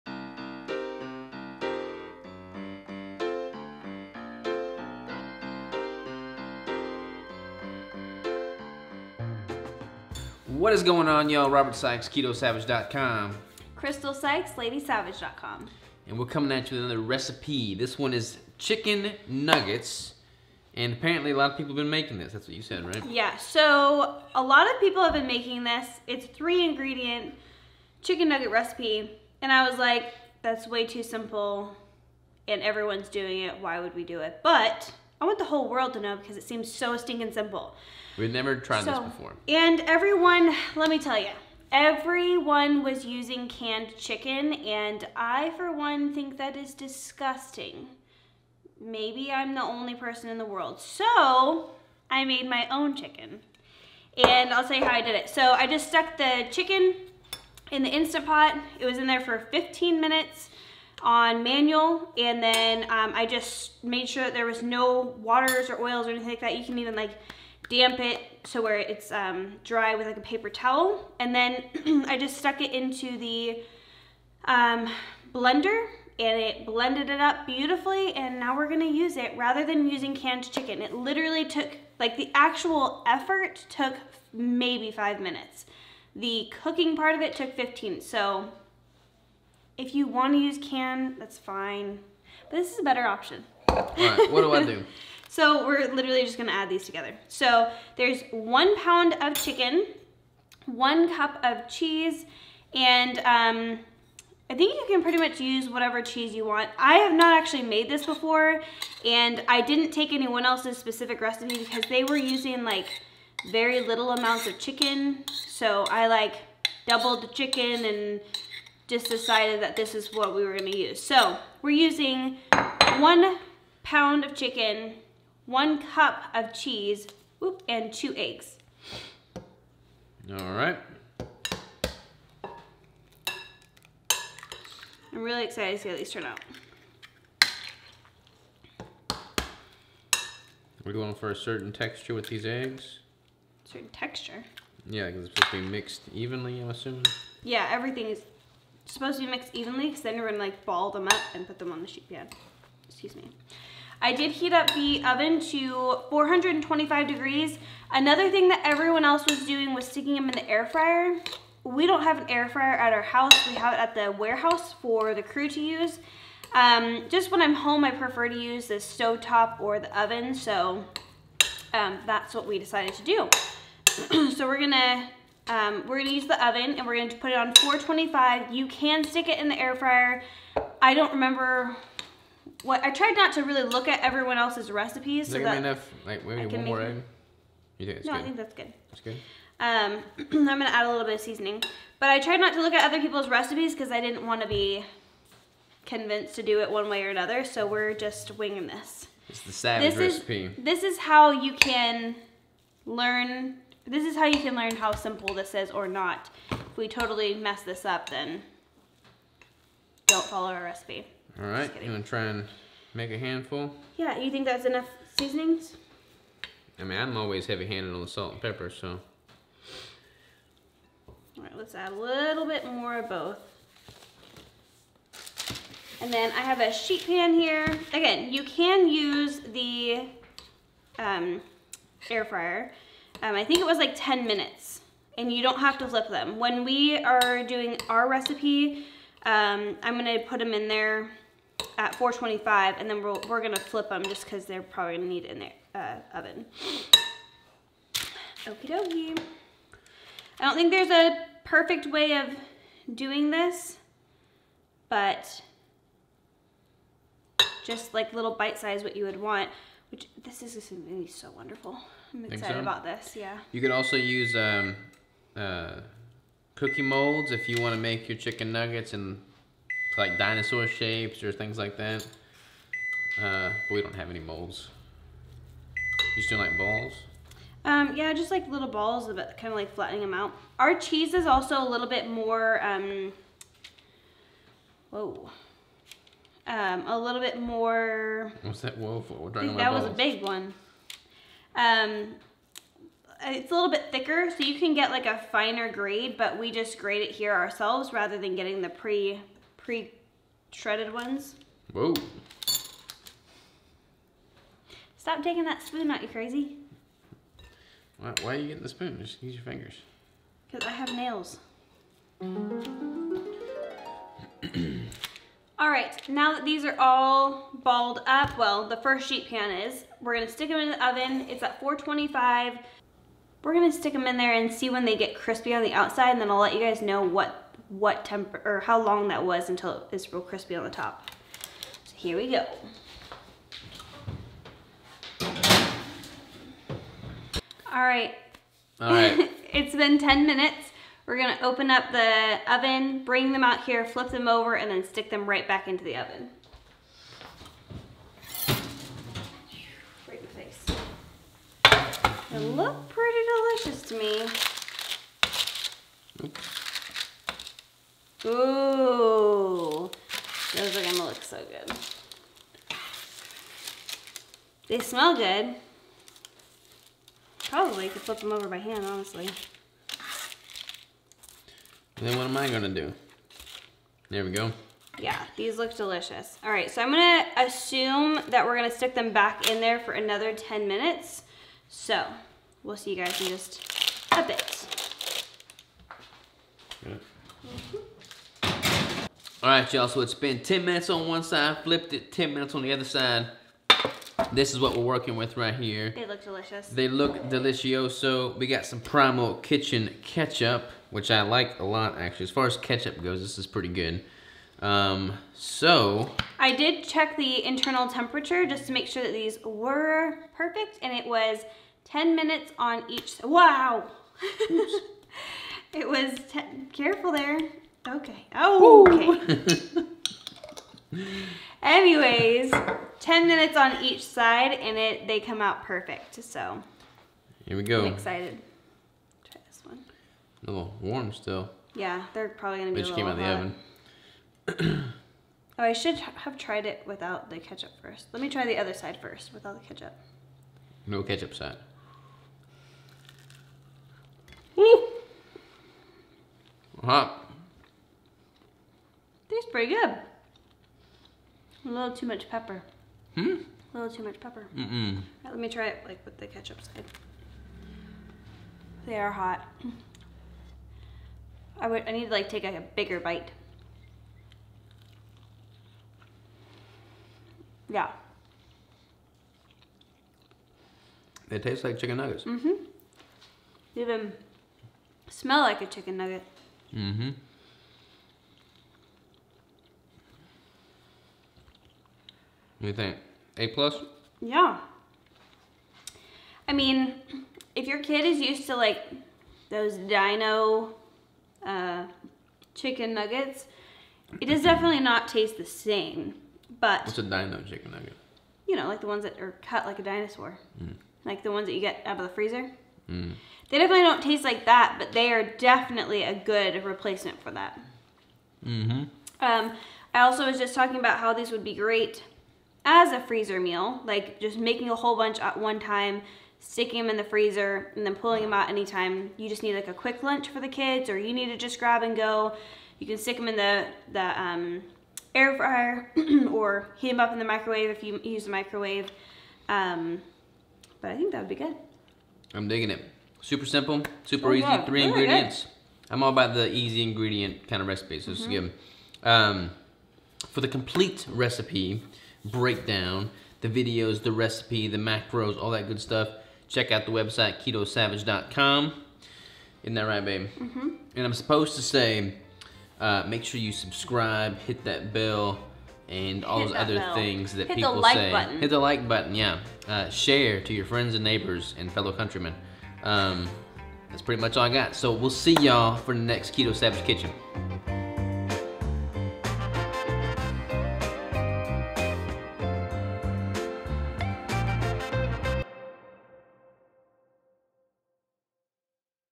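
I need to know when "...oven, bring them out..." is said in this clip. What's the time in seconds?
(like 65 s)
342 s.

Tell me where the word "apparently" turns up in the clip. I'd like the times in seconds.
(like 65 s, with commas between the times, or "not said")
20 s.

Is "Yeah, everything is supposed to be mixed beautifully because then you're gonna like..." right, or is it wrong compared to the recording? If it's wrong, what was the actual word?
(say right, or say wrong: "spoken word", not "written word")
wrong: "evenly", not "beautifully".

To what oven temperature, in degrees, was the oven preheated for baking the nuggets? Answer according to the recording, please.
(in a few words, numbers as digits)
425.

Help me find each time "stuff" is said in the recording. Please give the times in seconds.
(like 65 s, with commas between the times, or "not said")
545 s.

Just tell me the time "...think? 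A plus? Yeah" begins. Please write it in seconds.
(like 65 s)
482 s.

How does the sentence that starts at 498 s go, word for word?
You know, like the ones that are cut like a dinosaur, mm.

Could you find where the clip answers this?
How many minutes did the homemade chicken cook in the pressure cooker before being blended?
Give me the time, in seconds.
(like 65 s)
59 s.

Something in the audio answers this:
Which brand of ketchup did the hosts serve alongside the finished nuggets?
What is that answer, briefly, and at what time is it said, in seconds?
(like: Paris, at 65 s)
Primal Kitchen, at 398 s.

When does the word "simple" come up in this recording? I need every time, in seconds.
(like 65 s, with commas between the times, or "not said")
31 s, 37 s, 204 s, 533 s.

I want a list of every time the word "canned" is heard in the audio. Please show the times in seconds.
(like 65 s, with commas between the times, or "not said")
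43 s, 80 s.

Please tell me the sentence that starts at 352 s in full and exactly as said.
They look pretty delicious to me.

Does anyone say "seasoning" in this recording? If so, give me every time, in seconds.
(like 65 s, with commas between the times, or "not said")
191 s, 215 s.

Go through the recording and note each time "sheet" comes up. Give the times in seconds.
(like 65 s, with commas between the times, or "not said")
151 s, 226 s, 319 s.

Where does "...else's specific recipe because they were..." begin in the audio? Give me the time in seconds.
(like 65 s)
110 s.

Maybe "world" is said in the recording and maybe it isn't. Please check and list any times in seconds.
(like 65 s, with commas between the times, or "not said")
35 s, 50 s.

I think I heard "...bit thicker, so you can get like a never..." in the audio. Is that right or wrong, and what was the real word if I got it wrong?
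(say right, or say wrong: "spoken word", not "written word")
wrong: "finer", not "never".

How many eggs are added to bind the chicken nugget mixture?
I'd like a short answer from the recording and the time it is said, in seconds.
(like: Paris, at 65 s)
2, at 127 s.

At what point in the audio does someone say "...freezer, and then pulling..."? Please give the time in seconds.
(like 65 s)
517 s.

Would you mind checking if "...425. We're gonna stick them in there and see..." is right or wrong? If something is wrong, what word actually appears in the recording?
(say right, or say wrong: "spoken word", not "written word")
right.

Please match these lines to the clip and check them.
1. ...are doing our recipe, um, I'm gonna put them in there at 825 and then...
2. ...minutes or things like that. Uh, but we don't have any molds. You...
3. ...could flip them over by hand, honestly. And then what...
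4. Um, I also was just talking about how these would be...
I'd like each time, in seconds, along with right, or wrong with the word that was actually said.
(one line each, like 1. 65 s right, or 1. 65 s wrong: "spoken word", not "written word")
1. 237 s wrong: "425", not "825"
2. 270 s wrong: "shapes", not "minutes"
3. 367 s right
4. 509 s right.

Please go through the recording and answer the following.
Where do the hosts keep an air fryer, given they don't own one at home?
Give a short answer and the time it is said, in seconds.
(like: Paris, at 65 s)
the warehouse, at 163 s.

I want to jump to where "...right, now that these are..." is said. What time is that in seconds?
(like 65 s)
315 s.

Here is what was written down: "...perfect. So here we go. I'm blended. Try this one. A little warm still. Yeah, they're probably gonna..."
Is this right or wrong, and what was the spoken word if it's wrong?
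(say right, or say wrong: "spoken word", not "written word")
wrong: "excited", not "blended".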